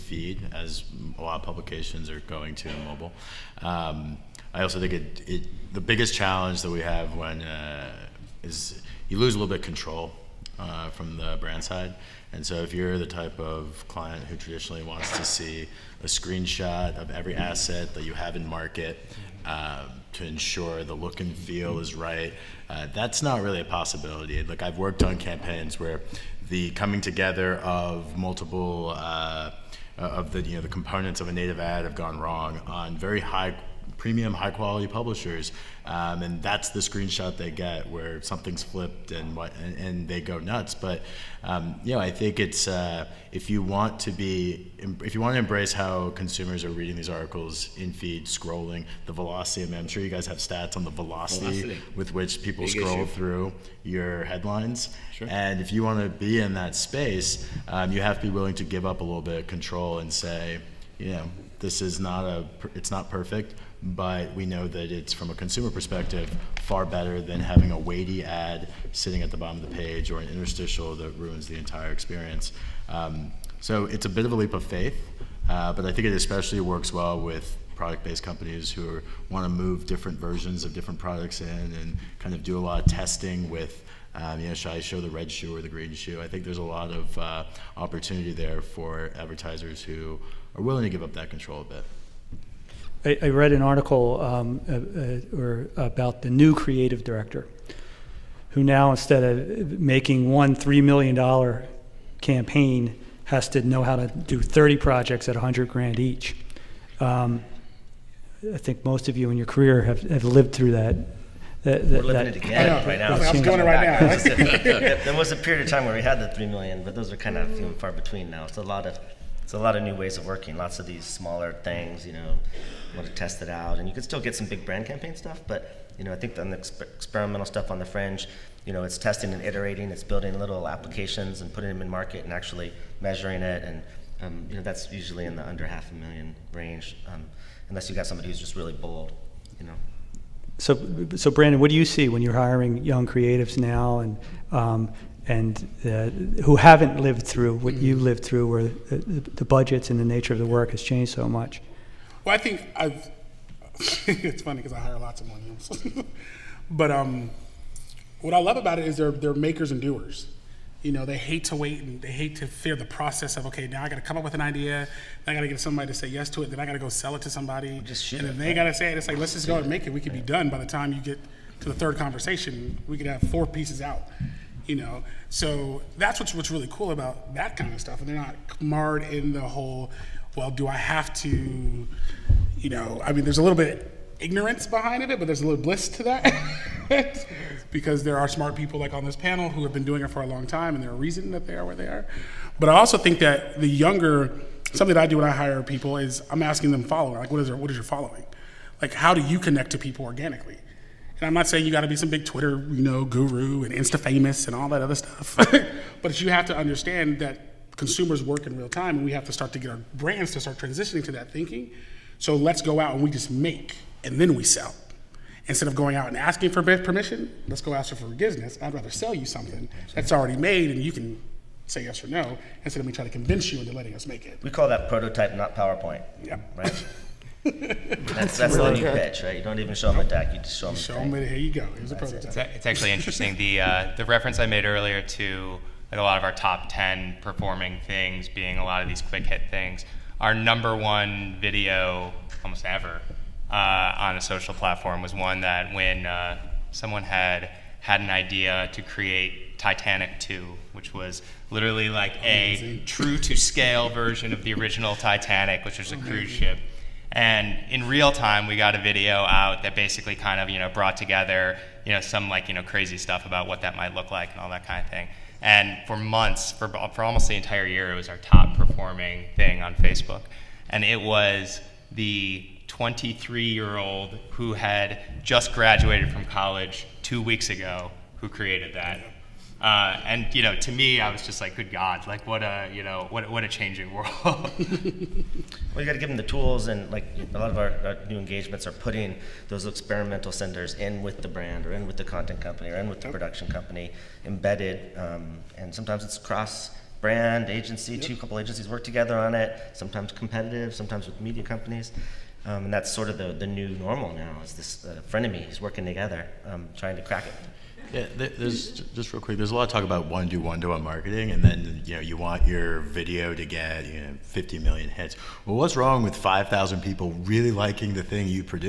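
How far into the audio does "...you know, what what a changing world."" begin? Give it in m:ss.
4:42.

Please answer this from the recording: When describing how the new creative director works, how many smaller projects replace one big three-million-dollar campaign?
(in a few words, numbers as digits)
30.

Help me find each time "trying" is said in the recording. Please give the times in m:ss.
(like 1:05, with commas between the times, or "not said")
3:42, 5:06.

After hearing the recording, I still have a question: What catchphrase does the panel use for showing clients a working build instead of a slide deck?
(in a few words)
prototype, not PowerPoint.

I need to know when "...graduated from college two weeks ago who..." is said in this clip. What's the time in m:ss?
4:35.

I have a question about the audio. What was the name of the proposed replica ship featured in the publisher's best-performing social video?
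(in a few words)
Titanic 2.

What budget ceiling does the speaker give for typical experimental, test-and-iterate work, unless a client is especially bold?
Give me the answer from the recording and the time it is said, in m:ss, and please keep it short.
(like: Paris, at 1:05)
under half a million, at 2:15.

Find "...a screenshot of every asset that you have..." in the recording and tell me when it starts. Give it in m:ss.
0:16.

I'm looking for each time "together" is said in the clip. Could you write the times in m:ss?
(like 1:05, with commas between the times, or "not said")
0:27, 4:20, 4:58, 5:05.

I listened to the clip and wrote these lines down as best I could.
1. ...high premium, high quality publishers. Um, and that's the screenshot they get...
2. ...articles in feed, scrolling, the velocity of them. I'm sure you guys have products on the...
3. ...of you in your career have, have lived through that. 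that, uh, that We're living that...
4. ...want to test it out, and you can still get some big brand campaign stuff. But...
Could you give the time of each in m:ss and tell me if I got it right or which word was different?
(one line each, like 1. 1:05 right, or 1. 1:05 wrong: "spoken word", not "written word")
1. 0:33 right
2. 0:47 wrong: "stats", not "products"
3. 1:49 right
4. 2:02 right.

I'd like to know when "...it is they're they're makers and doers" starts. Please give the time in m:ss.
2:38.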